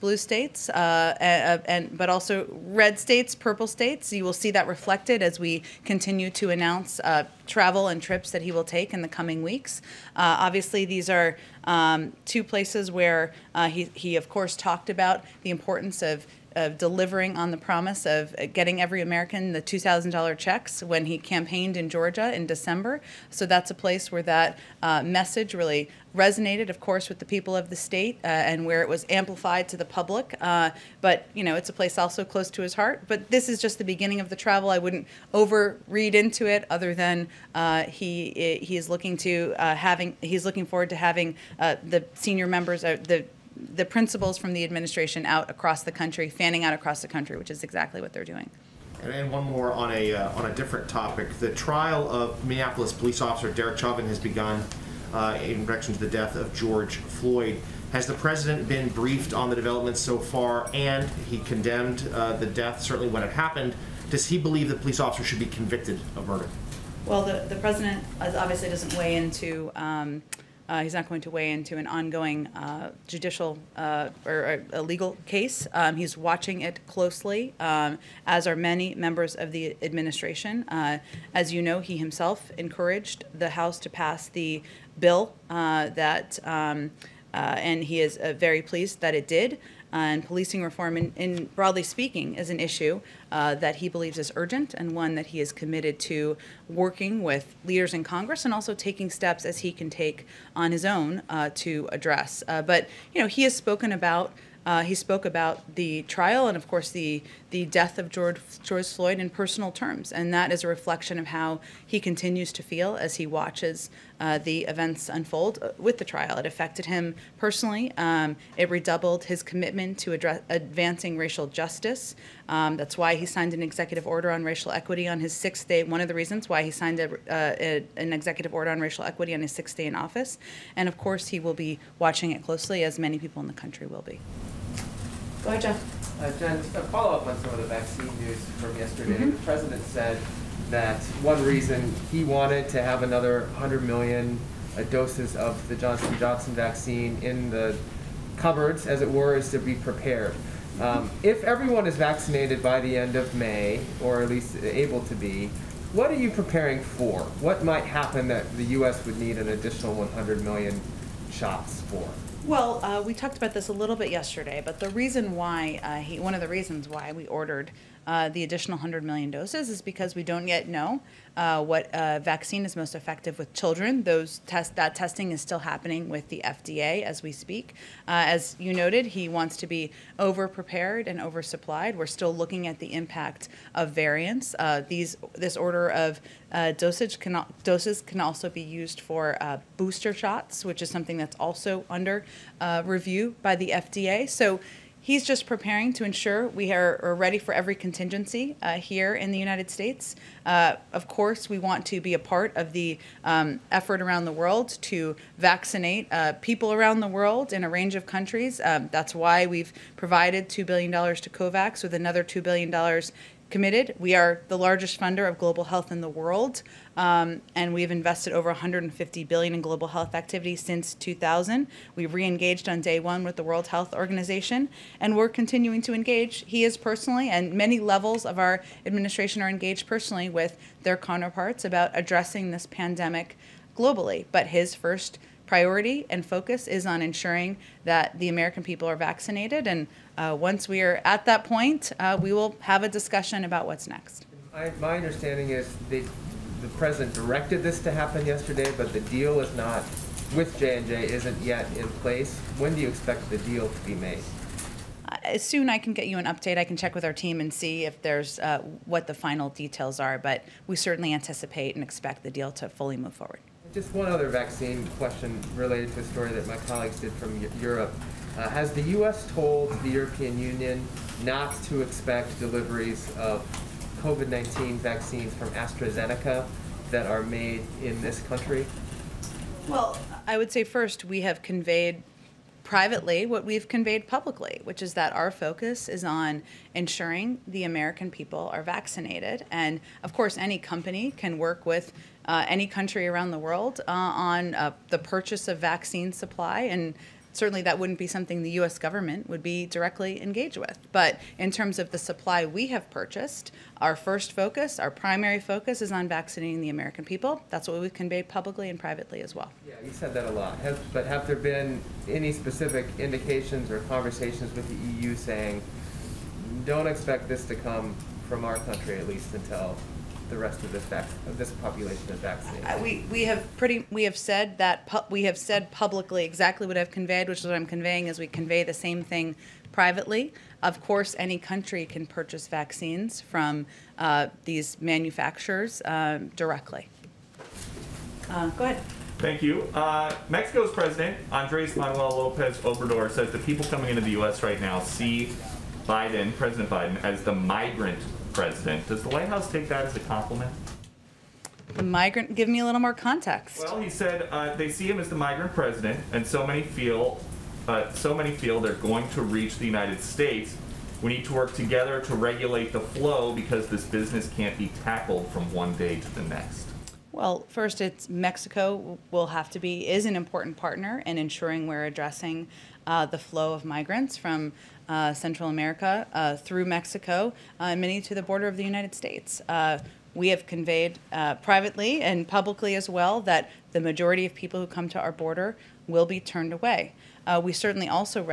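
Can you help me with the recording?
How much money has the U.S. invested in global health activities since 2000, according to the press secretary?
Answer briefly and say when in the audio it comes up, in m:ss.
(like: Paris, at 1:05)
150 billion, at 3:38.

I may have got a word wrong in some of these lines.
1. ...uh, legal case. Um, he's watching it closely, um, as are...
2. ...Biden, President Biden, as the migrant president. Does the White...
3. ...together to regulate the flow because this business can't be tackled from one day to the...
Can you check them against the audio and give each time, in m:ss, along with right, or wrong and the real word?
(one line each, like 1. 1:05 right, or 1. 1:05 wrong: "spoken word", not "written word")
1. 1:14 right
2. 5:45 right
3. 6:01 right.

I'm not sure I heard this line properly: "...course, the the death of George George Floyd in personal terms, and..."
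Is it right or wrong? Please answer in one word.
right.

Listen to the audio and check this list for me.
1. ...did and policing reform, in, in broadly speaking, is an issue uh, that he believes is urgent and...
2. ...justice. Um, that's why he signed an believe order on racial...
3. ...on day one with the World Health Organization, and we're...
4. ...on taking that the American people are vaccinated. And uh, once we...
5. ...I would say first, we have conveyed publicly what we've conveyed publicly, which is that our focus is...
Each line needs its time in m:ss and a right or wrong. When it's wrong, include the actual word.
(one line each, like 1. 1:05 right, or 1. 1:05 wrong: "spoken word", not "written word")
1. 1:29 right
2. 2:01 wrong: "executive", not "believe"
3. 3:42 right
4. 3:56 wrong: "ensuring", not "taking"
5. 4:40 wrong: "privately", not "publicly".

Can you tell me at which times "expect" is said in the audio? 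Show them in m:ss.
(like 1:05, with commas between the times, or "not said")
4:12, 4:21, 4:31, 5:16.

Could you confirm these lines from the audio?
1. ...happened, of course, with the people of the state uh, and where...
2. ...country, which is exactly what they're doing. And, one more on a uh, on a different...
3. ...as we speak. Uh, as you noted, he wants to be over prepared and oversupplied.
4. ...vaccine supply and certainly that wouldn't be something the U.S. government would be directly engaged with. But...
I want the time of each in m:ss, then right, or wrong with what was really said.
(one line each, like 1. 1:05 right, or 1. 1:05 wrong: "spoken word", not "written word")
1. 0:26 wrong: "resonated", not "happened"
2. 0:47 right
3. 2:57 right
4. 4:55 right.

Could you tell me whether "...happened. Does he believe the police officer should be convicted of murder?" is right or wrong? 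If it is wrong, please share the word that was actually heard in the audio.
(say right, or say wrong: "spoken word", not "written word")
right.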